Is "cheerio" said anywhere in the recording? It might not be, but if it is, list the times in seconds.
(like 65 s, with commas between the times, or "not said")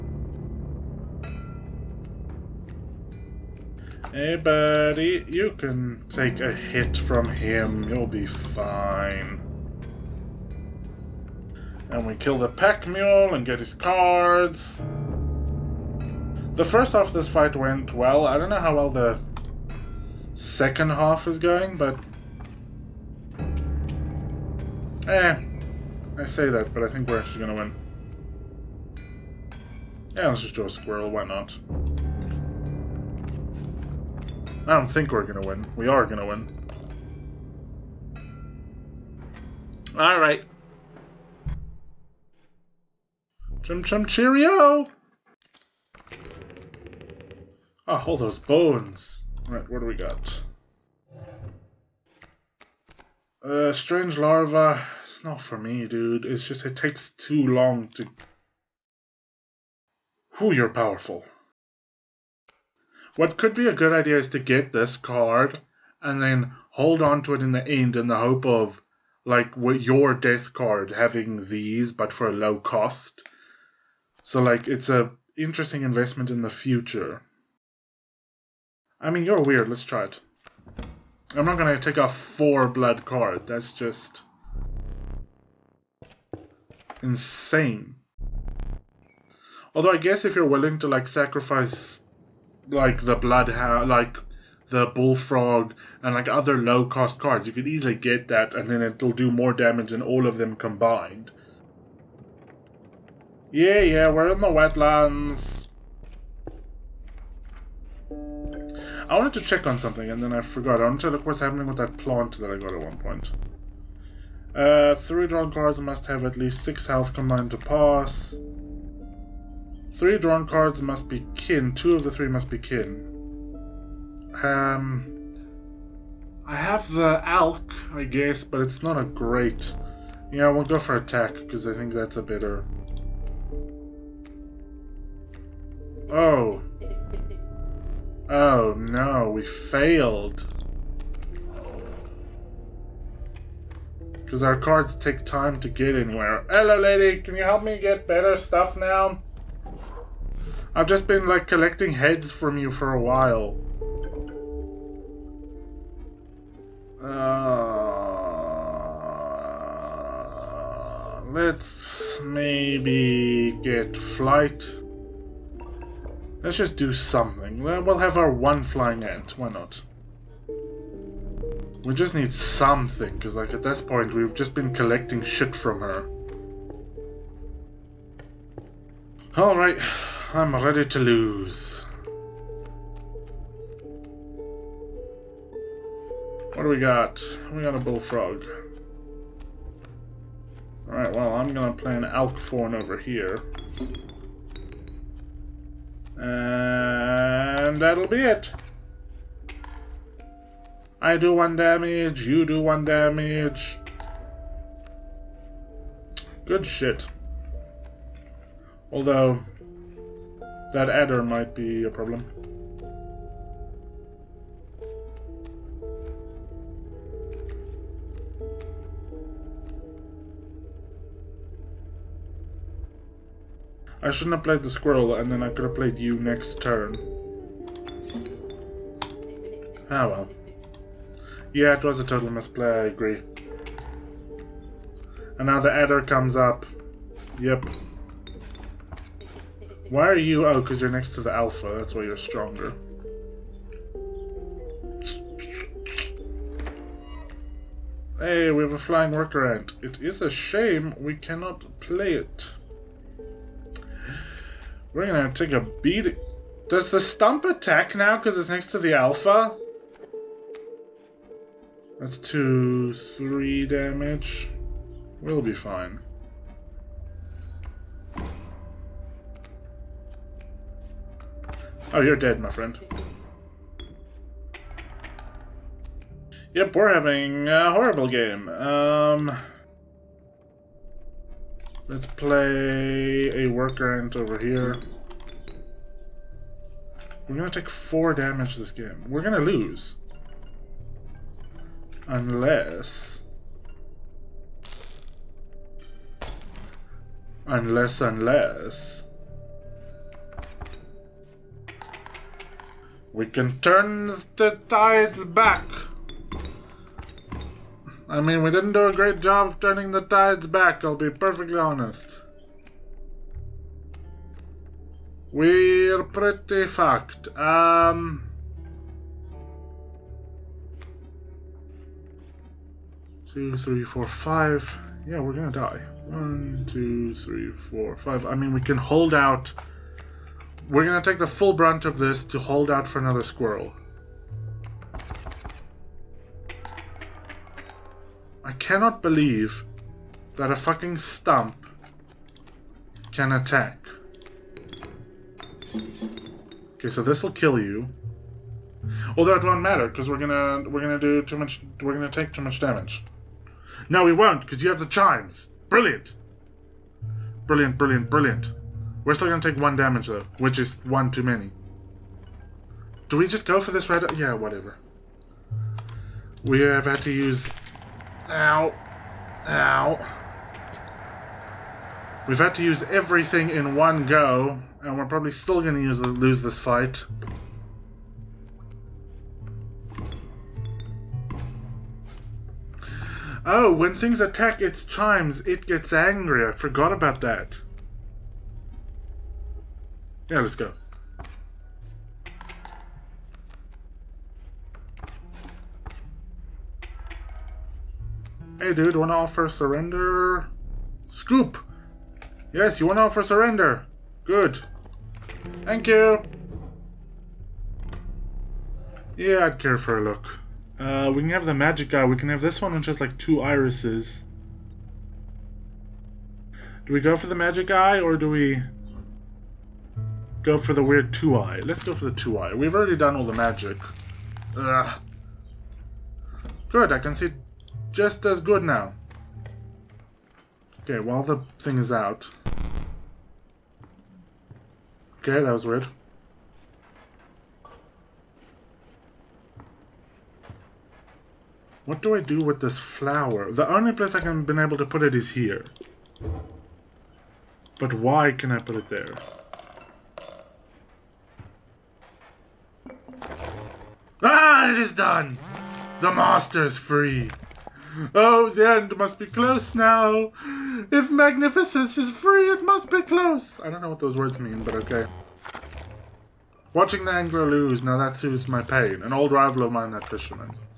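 44 s.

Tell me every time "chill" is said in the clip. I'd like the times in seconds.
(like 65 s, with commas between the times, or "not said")
not said.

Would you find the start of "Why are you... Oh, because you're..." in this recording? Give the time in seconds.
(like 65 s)
239 s.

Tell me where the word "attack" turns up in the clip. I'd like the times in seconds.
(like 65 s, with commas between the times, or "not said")
130 s, 257 s, 343 s, 384 s.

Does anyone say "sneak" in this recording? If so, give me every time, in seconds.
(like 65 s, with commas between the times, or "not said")
not said.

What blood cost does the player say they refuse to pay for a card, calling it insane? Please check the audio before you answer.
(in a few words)
4.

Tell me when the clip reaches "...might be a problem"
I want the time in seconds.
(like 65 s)
211 s.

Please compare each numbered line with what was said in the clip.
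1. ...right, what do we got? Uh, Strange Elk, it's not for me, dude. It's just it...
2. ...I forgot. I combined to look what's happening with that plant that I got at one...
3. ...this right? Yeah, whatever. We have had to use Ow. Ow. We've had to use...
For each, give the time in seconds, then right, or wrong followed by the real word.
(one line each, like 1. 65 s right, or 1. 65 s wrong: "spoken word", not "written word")
1. 49 s wrong: "Larva", not "Elk"
2. 110 s wrong: "wanted", not "combined"
3. 363 s right.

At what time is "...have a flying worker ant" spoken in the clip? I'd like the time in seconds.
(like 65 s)
248 s.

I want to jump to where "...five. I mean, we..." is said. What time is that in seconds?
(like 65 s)
327 s.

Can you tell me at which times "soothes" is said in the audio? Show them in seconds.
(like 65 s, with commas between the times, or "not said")
468 s.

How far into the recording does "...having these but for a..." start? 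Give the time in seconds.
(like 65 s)
70 s.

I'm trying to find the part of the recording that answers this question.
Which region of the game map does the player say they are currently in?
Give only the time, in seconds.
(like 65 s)
104 s.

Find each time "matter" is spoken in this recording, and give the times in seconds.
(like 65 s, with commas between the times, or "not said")
349 s.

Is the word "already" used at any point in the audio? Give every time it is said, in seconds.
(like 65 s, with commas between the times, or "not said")
422 s.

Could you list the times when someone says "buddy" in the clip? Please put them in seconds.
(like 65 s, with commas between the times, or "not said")
4 s.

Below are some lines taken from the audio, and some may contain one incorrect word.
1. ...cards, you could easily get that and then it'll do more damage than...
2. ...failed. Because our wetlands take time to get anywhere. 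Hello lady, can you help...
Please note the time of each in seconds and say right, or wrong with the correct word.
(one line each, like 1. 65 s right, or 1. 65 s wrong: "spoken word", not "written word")
1. 97 s right
2. 139 s wrong: "cards", not "wetlands".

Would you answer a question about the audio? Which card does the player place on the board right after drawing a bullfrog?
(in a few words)
Elk Fawn.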